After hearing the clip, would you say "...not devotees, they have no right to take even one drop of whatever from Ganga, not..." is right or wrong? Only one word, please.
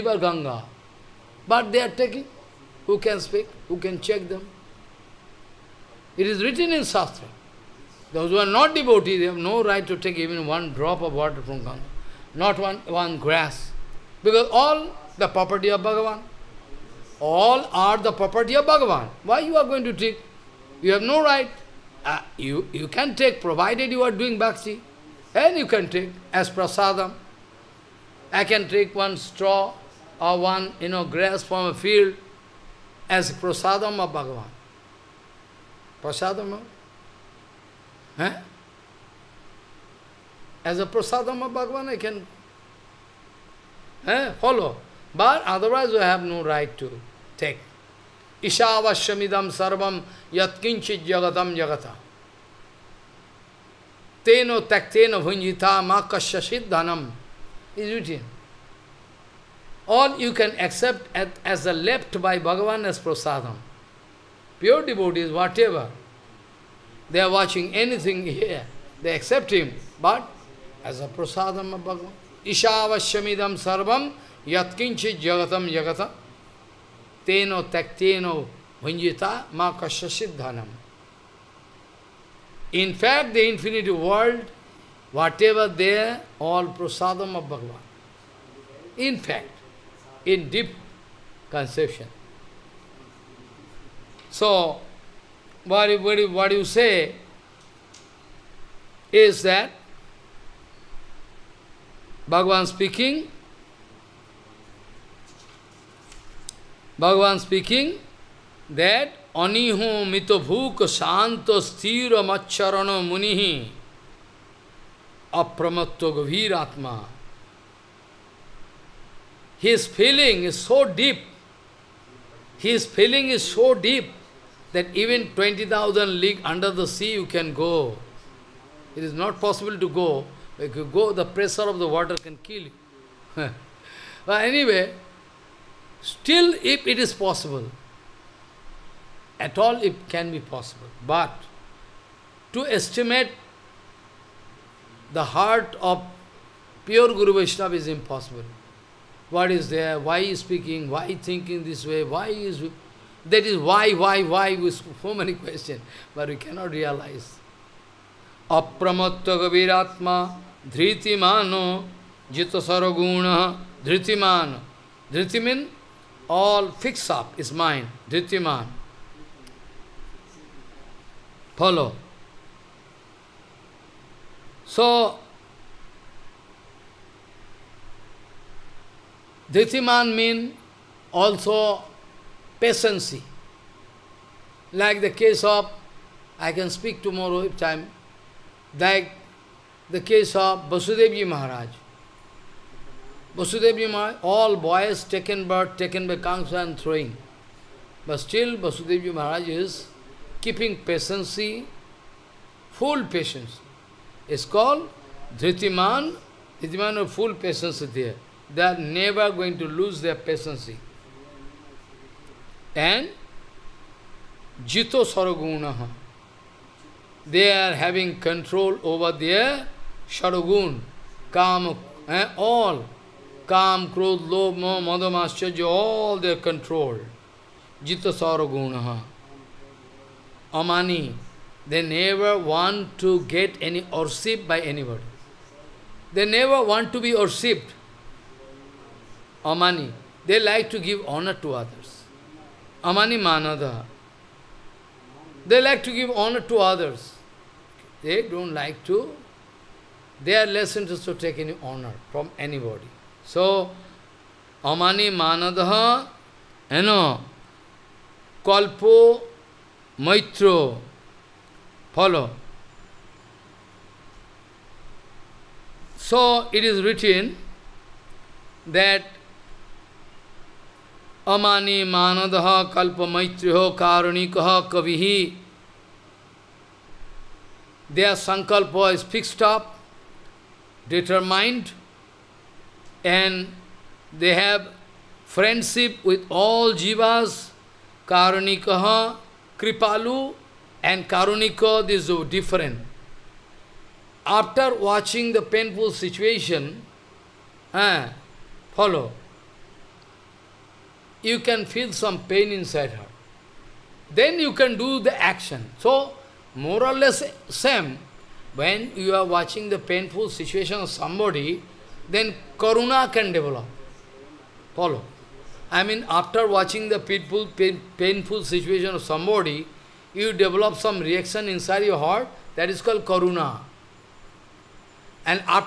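wrong.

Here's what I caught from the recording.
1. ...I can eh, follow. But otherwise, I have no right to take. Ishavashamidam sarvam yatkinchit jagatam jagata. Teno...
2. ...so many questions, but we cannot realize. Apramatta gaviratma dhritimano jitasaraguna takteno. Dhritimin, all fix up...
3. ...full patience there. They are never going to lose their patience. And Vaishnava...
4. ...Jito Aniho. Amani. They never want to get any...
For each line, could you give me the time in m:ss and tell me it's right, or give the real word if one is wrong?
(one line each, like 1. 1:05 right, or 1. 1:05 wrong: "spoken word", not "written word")
1. 0:41 right
2. 2:35 wrong: "dhritimano", not "takteno"
3. 3:27 wrong: "Jito", not "Vaishnava"
4. 3:48 wrong: "Saragunaha", not "Aniho".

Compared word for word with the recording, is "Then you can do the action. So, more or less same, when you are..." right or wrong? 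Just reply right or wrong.
right.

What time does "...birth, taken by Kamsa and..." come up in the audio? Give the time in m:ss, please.
3:15.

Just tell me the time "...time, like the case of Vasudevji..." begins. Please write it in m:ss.
3:07.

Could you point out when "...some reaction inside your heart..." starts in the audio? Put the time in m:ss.
5:20.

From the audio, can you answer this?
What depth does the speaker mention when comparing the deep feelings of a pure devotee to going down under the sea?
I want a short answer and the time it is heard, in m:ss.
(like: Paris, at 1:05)
20,000 league, at 2:05.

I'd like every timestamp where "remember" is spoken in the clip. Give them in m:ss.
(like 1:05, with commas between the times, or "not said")
not said.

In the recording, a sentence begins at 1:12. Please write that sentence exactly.
Ishavashyamidam sarvam yatkinchi jagatam jagata teno takteno hunjita ma kashyasiddhanam.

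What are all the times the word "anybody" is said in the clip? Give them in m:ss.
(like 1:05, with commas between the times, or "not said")
3:54, 4:12.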